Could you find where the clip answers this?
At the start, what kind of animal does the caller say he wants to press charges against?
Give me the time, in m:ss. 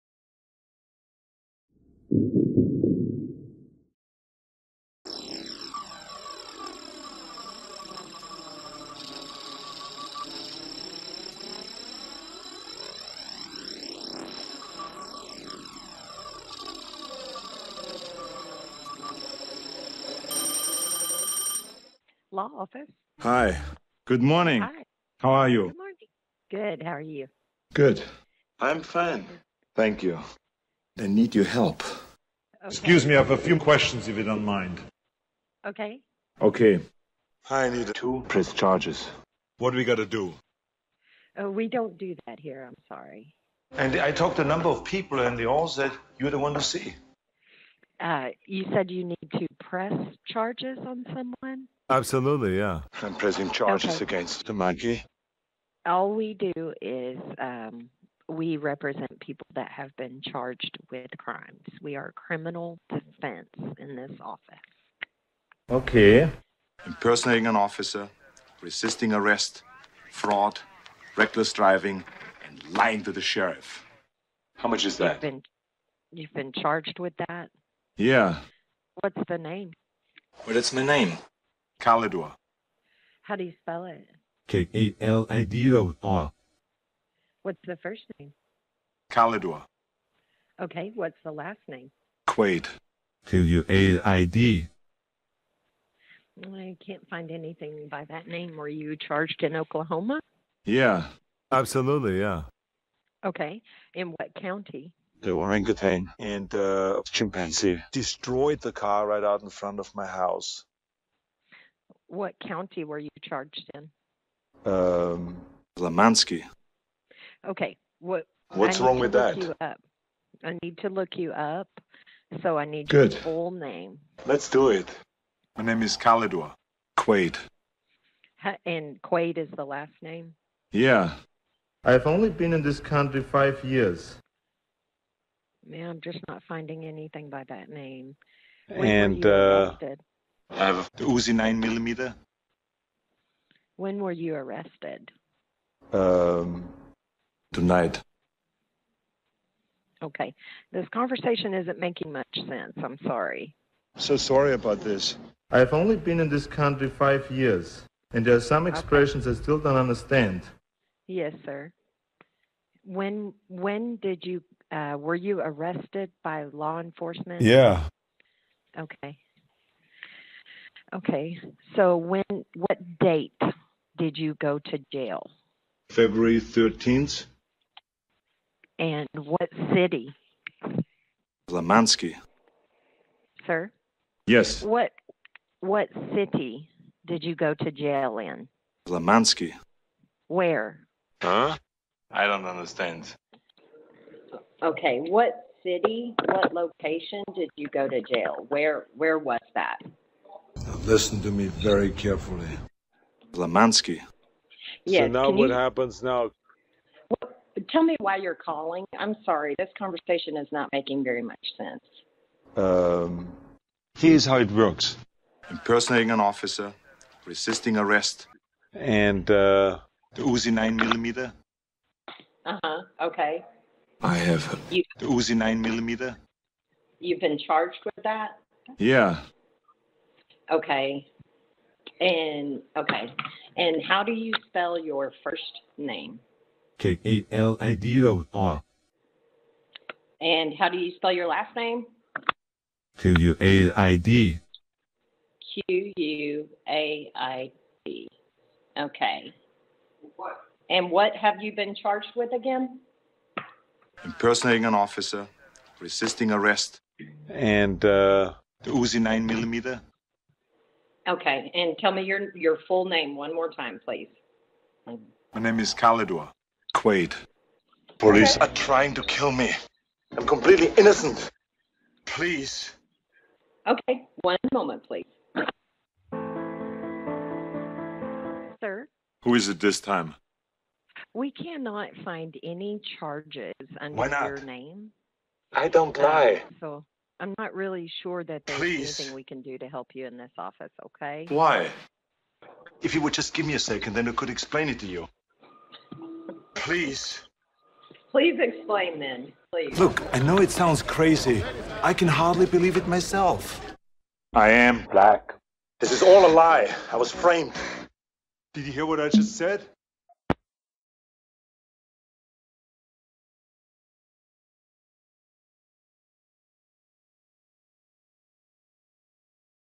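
0:54.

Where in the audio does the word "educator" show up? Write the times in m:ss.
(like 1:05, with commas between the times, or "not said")
not said.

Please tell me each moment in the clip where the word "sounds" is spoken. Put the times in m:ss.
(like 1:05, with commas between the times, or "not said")
5:00.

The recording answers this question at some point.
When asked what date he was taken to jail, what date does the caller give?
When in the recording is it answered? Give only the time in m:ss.
2:55.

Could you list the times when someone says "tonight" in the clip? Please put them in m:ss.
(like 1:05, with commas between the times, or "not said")
2:27.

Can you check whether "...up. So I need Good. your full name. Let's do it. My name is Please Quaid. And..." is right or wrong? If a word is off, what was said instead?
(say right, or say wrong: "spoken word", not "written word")
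wrong: "Kalidwa", not "Please".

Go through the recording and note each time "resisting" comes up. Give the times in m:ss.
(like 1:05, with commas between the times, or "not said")
1:08, 3:37, 4:15.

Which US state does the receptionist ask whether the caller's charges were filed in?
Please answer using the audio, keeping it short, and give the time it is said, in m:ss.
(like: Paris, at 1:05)
Oklahoma, at 1:39.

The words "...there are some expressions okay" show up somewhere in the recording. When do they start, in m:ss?
2:38.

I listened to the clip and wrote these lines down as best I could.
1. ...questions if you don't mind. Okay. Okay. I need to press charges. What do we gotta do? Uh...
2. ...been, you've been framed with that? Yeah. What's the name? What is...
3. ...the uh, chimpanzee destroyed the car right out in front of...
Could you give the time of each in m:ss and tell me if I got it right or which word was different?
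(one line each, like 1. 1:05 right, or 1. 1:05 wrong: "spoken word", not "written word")
1. 0:33 right
2. 1:15 wrong: "charged", not "framed"
3. 1:46 right.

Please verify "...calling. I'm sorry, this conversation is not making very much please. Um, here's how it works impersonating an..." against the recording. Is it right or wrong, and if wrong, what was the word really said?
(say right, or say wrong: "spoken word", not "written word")
wrong: "sense", not "please".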